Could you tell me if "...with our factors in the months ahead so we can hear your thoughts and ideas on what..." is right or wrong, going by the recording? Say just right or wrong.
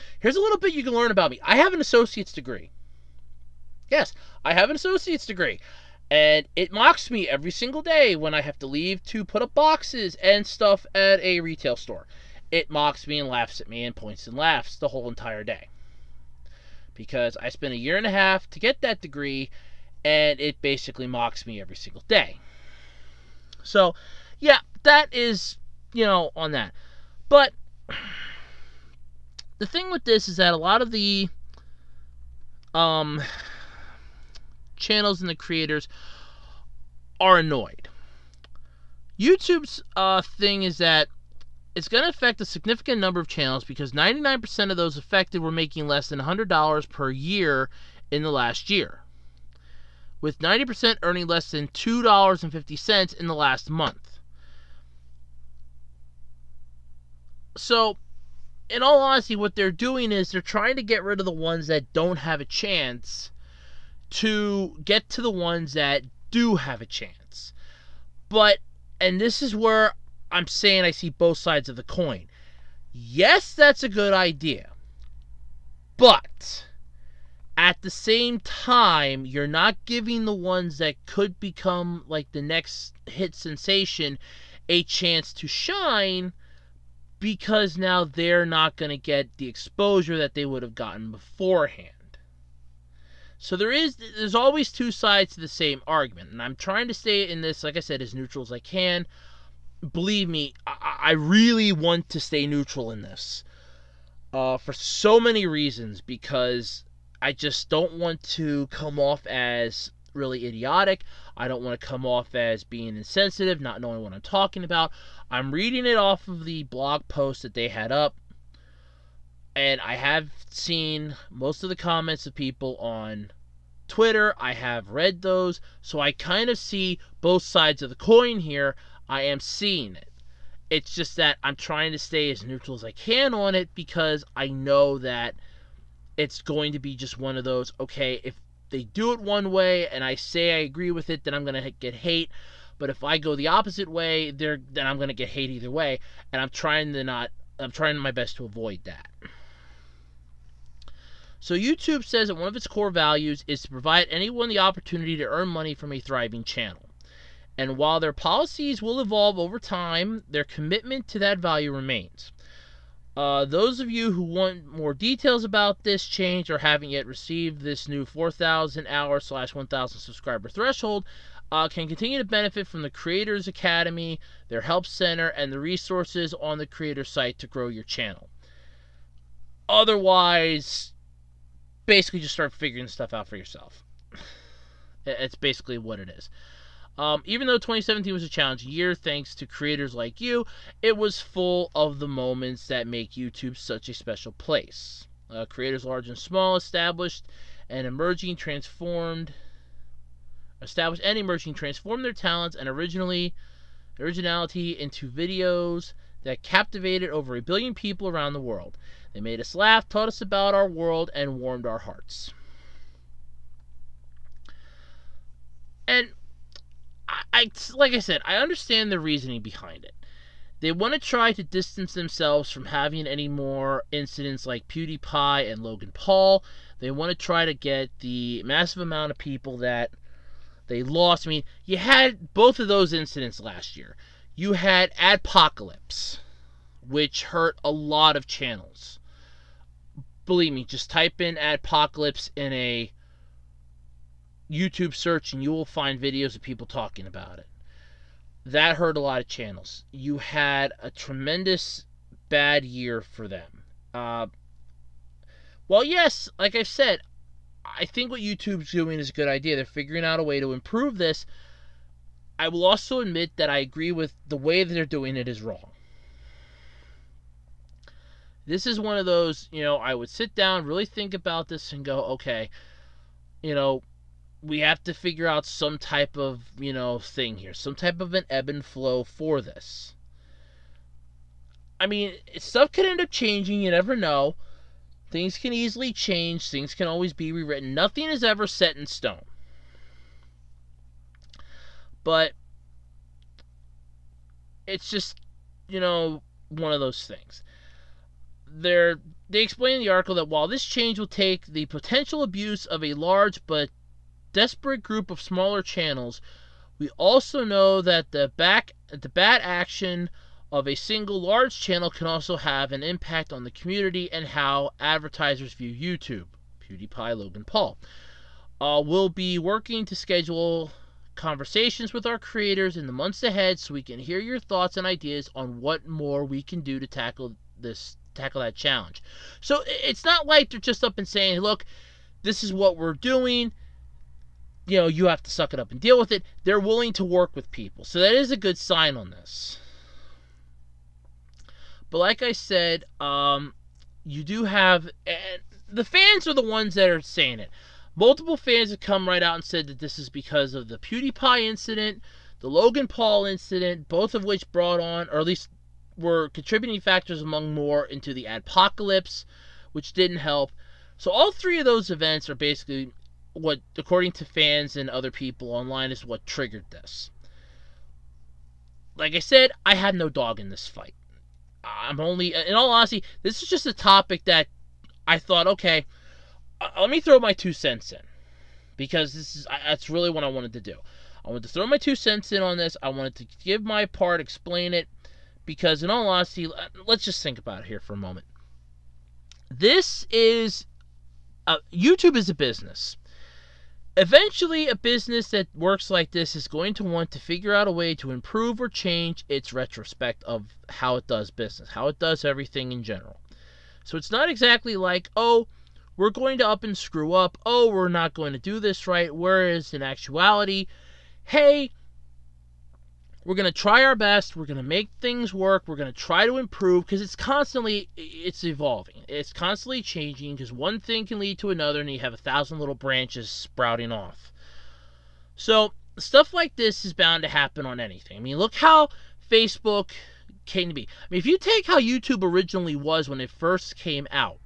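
wrong.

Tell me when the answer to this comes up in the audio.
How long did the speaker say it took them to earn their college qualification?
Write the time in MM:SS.
00:17.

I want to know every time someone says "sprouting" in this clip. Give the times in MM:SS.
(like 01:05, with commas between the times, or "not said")
07:03.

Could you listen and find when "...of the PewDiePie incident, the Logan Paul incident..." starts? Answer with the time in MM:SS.
05:50.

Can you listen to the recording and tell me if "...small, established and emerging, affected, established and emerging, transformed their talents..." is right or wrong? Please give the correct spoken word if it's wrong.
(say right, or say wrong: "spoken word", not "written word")
wrong: "transformed", not "affected".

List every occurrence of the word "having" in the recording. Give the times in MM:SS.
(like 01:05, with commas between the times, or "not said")
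03:42.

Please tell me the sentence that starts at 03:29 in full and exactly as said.
They made us laugh, taught us about our world, and warmed our hearts.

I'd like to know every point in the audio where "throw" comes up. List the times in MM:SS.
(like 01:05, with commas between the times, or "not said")
06:17, 06:21.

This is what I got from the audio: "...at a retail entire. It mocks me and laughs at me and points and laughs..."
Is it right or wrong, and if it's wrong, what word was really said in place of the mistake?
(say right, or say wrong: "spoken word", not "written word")
wrong: "store", not "entire".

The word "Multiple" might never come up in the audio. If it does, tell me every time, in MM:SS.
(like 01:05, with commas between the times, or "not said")
05:47.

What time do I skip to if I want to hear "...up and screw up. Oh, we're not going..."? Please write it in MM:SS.
06:46.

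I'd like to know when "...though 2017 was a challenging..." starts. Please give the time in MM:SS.
03:07.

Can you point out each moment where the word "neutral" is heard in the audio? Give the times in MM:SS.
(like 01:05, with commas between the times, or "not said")
01:38, 01:42, 02:12.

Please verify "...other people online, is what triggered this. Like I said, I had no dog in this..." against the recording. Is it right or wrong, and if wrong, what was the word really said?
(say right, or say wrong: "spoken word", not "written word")
right.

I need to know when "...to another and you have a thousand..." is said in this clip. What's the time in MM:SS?
07:01.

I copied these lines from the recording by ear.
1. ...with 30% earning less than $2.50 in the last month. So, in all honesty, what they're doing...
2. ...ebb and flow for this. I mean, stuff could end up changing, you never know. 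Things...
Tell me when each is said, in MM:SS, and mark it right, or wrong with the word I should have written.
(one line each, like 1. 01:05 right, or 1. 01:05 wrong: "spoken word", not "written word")
1. 00:50 wrong: "90", not "30"
2. 04:38 right.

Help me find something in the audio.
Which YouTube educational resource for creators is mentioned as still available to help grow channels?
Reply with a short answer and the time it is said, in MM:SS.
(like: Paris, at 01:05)
Creators Academy, at 02:52.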